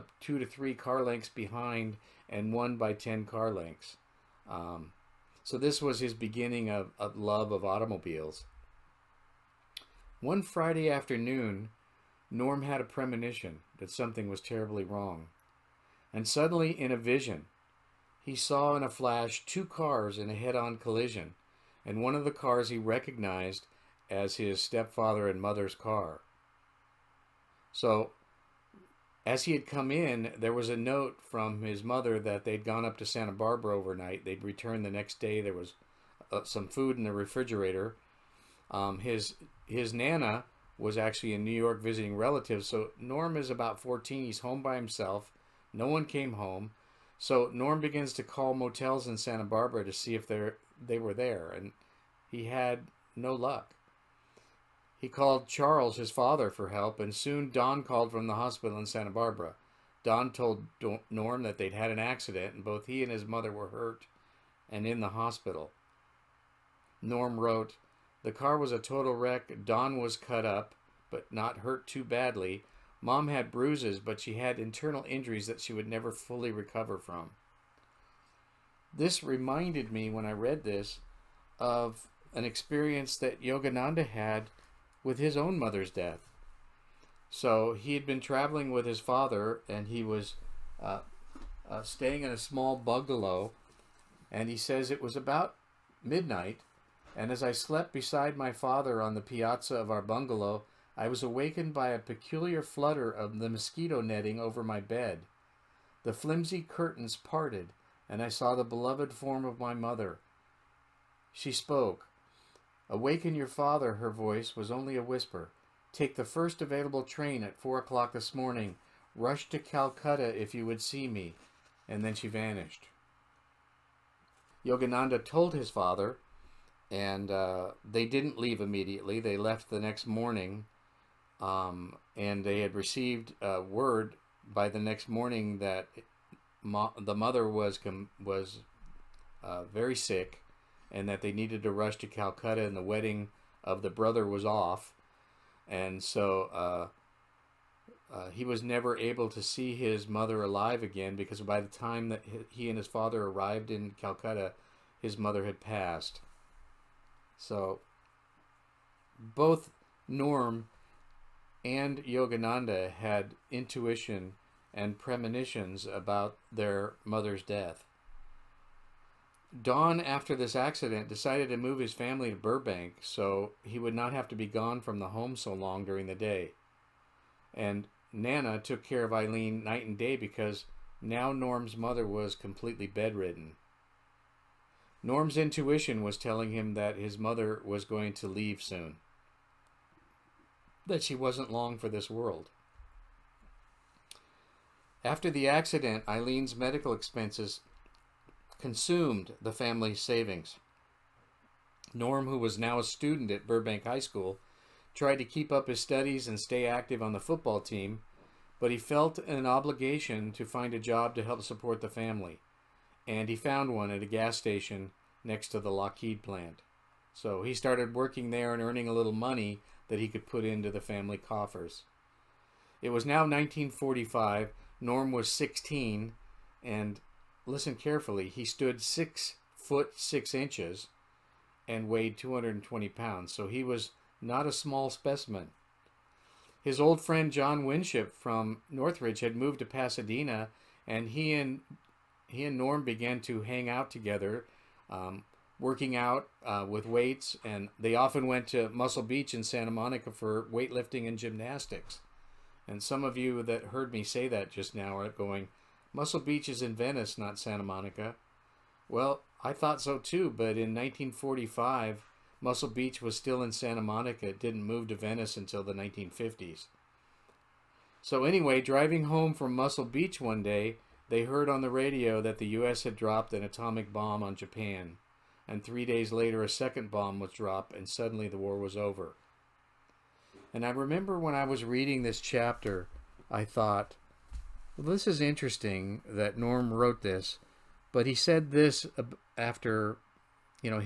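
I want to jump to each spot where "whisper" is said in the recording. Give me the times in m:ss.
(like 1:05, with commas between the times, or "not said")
1:55.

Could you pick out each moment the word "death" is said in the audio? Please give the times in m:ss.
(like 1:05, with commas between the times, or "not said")
1:25, 2:47.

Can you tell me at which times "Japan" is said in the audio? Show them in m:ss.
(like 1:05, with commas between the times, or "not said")
4:34.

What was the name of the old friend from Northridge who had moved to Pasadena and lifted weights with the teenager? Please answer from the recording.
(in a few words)
John Winship.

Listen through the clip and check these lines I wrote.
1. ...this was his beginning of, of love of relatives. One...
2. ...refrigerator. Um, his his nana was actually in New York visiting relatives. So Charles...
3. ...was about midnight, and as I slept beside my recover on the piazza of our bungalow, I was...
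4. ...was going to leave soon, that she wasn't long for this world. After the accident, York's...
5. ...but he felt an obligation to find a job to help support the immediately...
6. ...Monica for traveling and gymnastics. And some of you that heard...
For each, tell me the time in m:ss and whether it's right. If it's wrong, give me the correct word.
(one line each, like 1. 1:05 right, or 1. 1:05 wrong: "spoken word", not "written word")
1. 0:05 wrong: "automobiles", not "relatives"
2. 0:37 wrong: "Norm", not "Charles"
3. 1:34 wrong: "father", not "recover"
4. 3:07 wrong: "Eileen", not "York"
5. 3:28 wrong: "family", not "immediately"
6. 4:09 wrong: "weightlifting", not "traveling".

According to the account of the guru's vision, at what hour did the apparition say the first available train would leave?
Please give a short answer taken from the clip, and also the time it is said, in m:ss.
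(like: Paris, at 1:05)
4 o'clock, at 1:57.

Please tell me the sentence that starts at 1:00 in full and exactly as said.
Don told Norm that they'd had an accident, and both he and his mother were hurt and in the hospital.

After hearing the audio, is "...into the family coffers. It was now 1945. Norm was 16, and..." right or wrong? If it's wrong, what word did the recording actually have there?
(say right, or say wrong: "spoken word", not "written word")
right.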